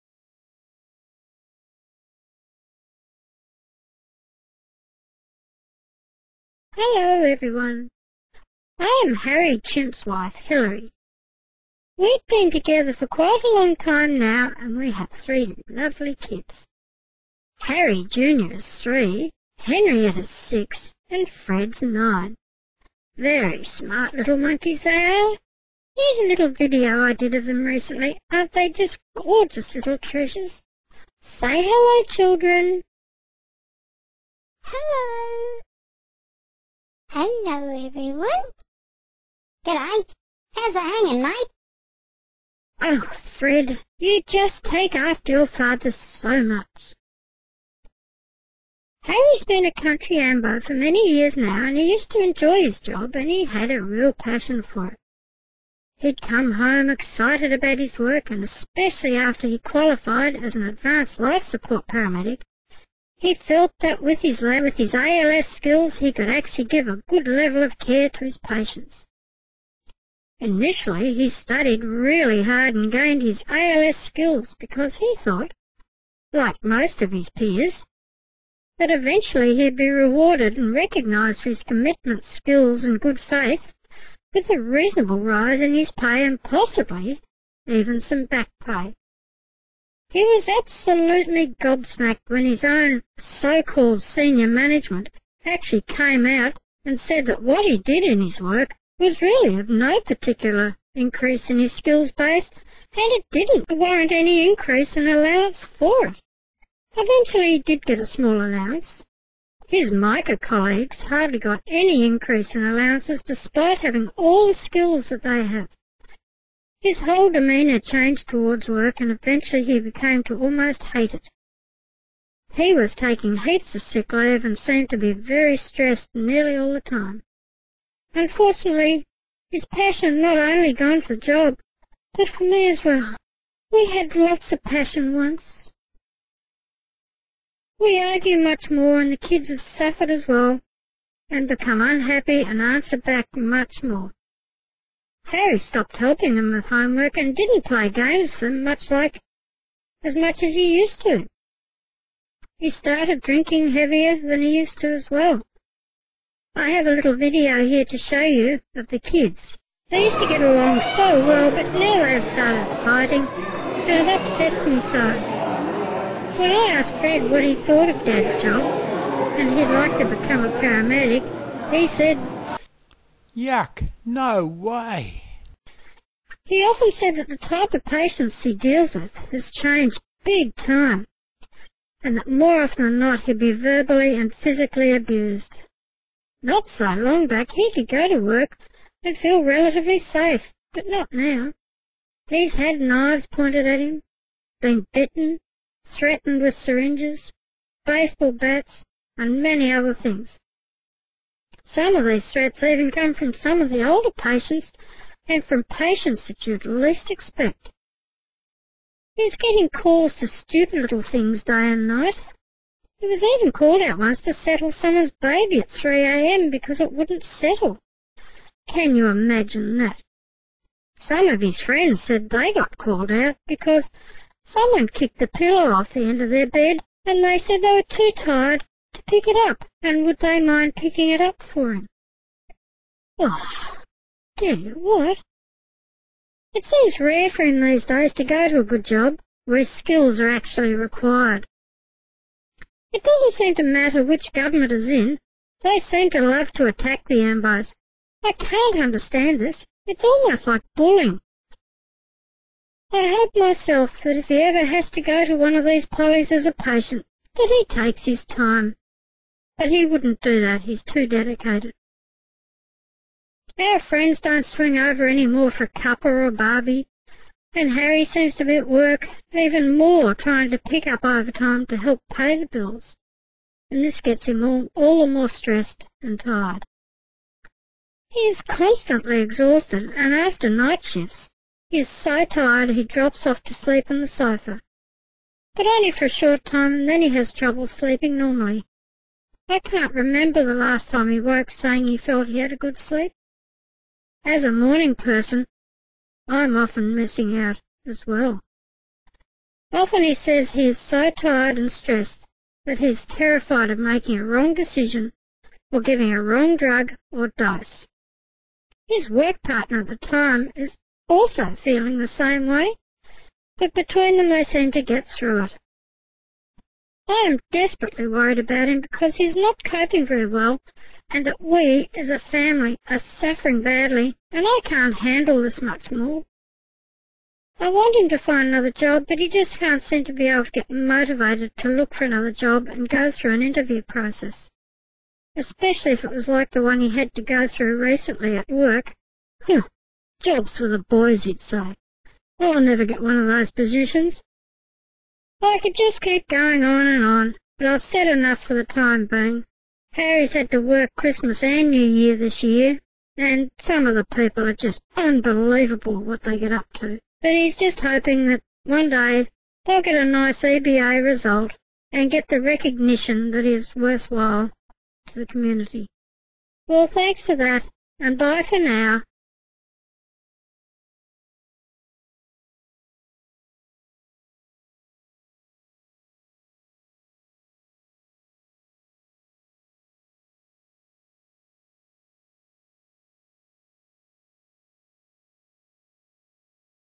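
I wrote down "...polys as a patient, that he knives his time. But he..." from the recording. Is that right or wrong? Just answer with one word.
wrong.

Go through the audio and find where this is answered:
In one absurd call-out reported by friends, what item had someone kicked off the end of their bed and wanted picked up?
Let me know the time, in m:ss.
3:45.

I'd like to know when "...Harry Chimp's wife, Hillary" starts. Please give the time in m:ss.
0:09.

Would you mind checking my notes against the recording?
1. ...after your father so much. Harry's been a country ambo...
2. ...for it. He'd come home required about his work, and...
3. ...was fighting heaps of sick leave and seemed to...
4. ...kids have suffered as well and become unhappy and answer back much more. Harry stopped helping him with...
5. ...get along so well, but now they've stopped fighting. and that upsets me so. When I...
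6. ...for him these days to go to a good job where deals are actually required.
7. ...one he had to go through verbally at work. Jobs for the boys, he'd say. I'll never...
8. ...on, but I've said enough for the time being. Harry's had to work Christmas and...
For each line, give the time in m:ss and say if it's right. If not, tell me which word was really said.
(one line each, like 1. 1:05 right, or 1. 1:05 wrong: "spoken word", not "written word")
1. 0:44 right
2. 0:54 wrong: "excited", not "required"
3. 2:02 wrong: "taking", not "fighting"
4. 2:19 right
5. 2:40 wrong: "started", not "stopped"
6. 3:57 wrong: "skills", not "deals"
7. 5:36 wrong: "recently", not "verbally"
8. 5:47 right.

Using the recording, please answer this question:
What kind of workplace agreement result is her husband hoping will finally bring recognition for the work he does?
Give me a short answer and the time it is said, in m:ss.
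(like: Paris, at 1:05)
EBA, at 6:00.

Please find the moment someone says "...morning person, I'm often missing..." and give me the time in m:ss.
4:54.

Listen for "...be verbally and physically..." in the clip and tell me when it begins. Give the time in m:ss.
3:03.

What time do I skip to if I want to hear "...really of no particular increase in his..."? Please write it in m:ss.
1:39.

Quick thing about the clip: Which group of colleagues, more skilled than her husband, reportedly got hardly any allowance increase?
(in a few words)
MICA.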